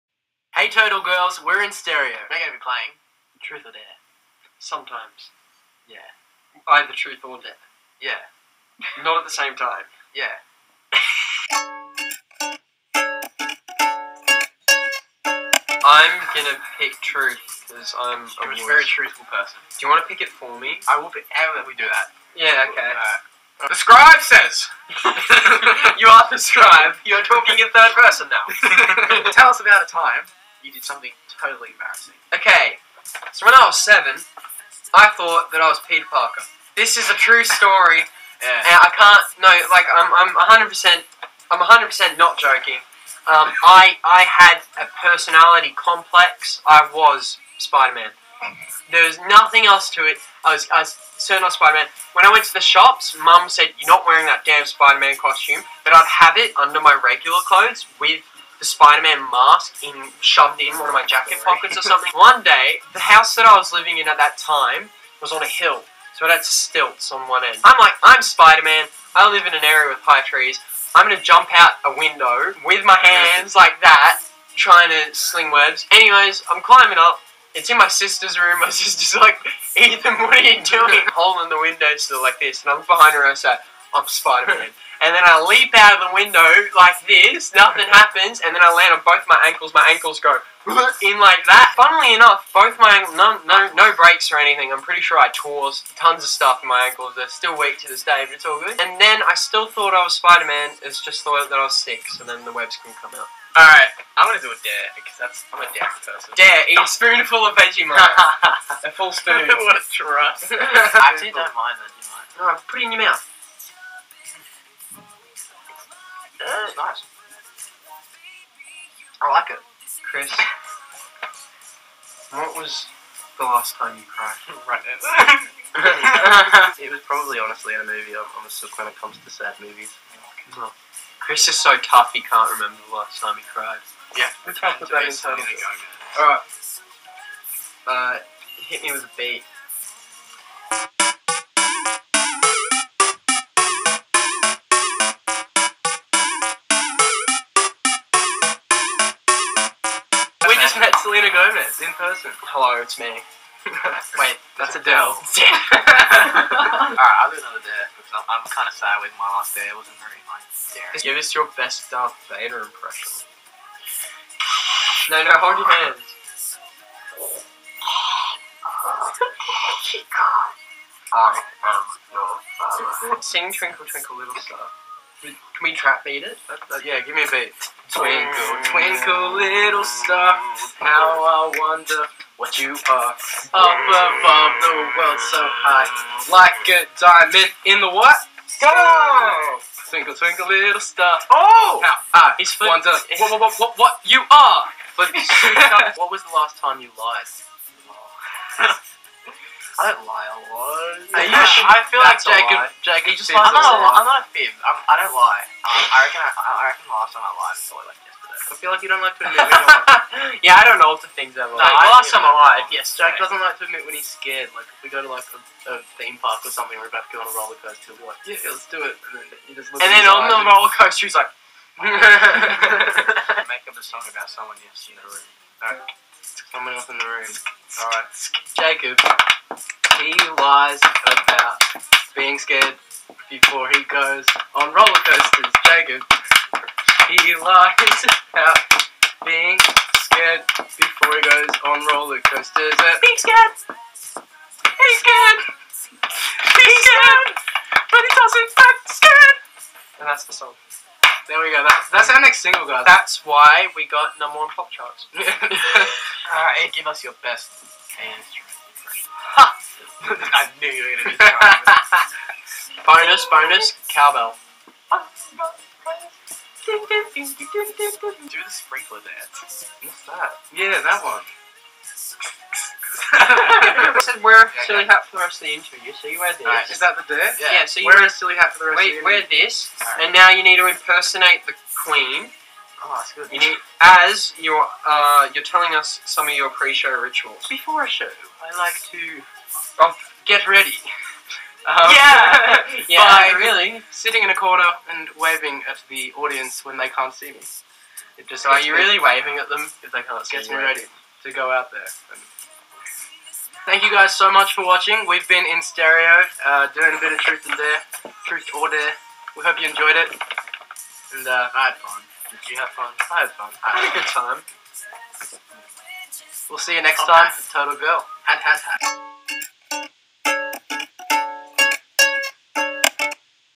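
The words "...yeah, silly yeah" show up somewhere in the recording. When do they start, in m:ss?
4:34.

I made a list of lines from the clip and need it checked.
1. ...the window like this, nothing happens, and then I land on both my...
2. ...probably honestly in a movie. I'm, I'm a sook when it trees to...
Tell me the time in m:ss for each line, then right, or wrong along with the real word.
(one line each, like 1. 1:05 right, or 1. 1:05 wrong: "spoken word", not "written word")
1. 1:26 right
2. 2:07 wrong: "comes", not "trees".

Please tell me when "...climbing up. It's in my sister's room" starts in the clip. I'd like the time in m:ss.
1:16.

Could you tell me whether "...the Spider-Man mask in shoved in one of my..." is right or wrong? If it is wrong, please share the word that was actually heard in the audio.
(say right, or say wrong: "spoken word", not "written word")
right.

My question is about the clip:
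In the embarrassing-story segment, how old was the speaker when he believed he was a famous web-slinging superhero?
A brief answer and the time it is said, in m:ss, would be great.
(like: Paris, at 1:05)
7, at 0:33.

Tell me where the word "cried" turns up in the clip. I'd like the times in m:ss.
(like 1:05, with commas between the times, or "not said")
2:04, 2:13.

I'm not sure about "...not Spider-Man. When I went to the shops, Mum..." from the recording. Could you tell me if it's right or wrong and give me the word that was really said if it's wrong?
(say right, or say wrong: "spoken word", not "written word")
right.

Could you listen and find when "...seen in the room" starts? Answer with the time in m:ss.
3:44.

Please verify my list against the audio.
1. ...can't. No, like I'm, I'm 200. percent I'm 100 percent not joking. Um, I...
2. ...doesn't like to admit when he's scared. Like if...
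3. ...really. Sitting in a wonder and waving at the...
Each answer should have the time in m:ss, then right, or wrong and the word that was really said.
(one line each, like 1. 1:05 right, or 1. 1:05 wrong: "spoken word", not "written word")
1. 0:38 wrong: "100", not "200"
2. 3:33 right
3. 4:53 wrong: "corner", not "wonder".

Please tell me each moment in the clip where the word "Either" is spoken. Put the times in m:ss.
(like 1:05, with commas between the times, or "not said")
0:06.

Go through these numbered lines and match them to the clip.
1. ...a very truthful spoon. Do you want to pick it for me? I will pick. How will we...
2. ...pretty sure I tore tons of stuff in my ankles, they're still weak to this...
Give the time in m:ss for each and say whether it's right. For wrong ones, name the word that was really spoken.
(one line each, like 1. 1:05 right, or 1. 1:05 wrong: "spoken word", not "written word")
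1. 0:18 wrong: "person", not "spoon"
2. 1:34 right.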